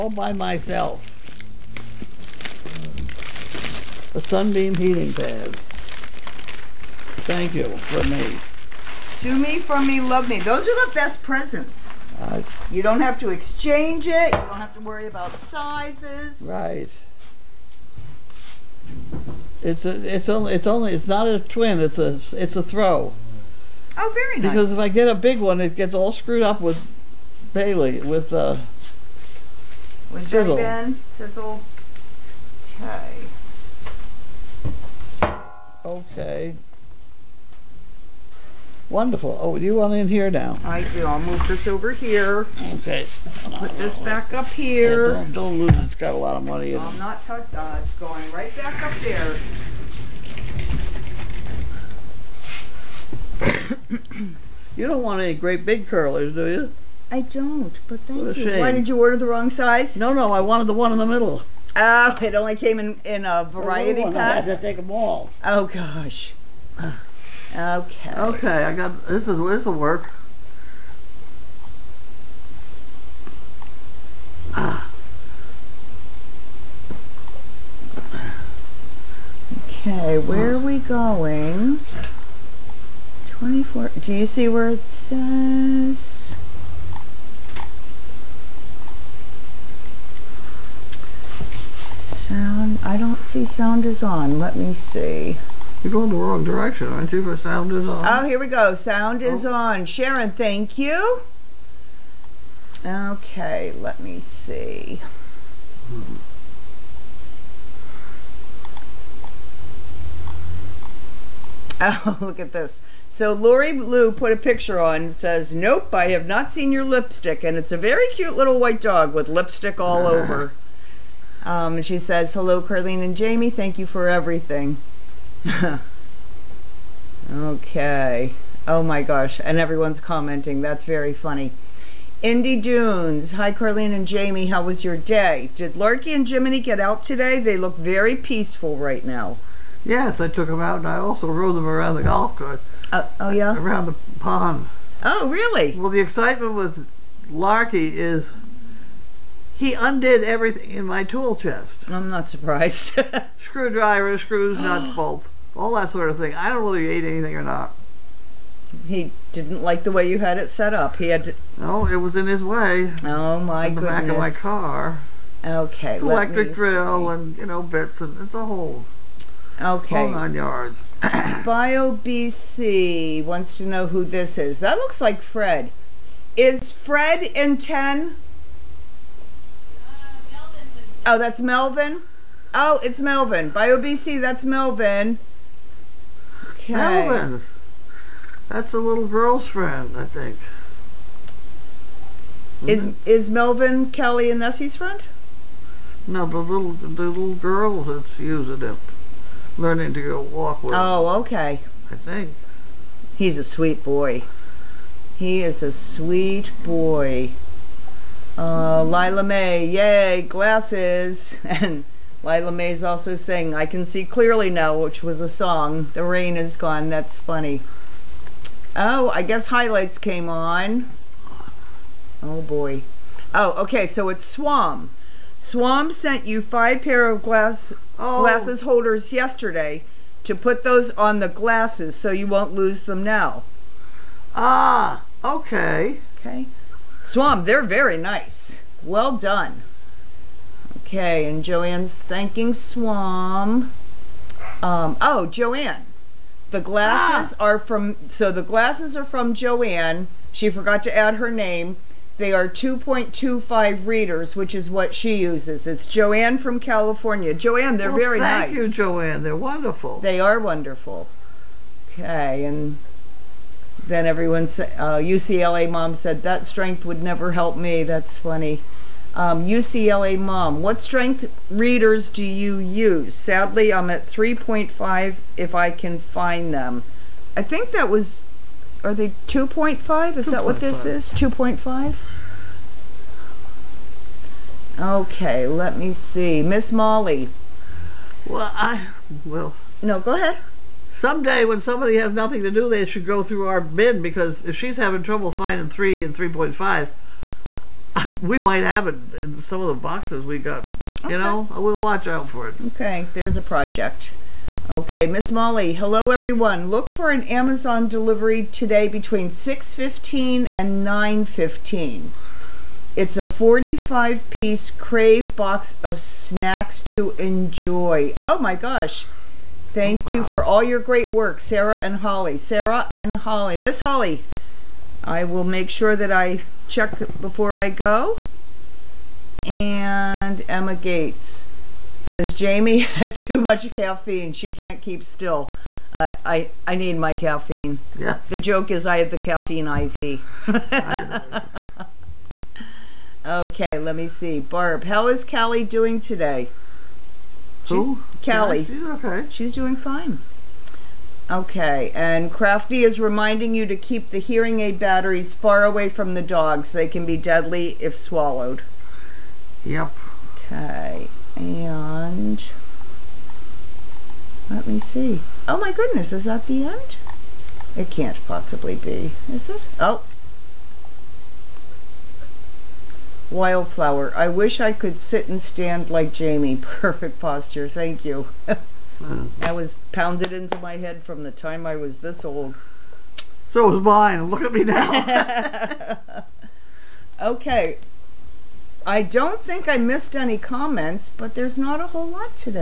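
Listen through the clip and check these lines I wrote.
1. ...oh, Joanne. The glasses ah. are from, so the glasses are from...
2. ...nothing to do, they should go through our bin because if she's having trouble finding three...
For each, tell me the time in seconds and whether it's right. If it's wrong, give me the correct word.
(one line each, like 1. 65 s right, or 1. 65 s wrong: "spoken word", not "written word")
1. 245 s right
2. 292 s right.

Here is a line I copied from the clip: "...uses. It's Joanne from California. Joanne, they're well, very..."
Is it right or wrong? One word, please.
right.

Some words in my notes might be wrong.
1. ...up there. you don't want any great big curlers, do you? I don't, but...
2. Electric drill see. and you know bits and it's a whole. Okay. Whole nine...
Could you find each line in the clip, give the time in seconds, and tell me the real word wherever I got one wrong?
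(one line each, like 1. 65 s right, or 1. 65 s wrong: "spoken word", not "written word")
1. 48 s right
2. 165 s right.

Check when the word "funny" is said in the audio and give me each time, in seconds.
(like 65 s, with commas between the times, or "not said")
131 s, 217 s, 268 s.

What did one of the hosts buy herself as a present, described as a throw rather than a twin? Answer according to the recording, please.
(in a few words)
Sunbeam heating pad.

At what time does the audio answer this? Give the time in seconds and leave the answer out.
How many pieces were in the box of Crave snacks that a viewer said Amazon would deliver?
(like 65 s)
313 s.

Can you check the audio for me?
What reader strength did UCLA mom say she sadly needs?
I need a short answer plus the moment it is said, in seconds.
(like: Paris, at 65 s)
3.5, at 274 s.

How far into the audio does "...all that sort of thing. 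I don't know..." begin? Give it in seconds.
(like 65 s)
155 s.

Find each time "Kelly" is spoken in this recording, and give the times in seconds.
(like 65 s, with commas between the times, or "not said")
193 s.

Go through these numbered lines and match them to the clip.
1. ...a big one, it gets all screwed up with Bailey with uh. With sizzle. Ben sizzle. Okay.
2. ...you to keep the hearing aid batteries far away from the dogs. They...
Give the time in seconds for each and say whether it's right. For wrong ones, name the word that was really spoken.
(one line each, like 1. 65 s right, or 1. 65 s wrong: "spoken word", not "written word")
1. 25 s right
2. 353 s right.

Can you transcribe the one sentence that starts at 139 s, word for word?
Yes, I took them out and I also rode them around the golf course.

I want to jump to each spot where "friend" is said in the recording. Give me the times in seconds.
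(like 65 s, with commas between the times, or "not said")
189 s, 194 s.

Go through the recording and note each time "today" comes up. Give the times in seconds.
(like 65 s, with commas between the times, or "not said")
137 s, 308 s, 345 s.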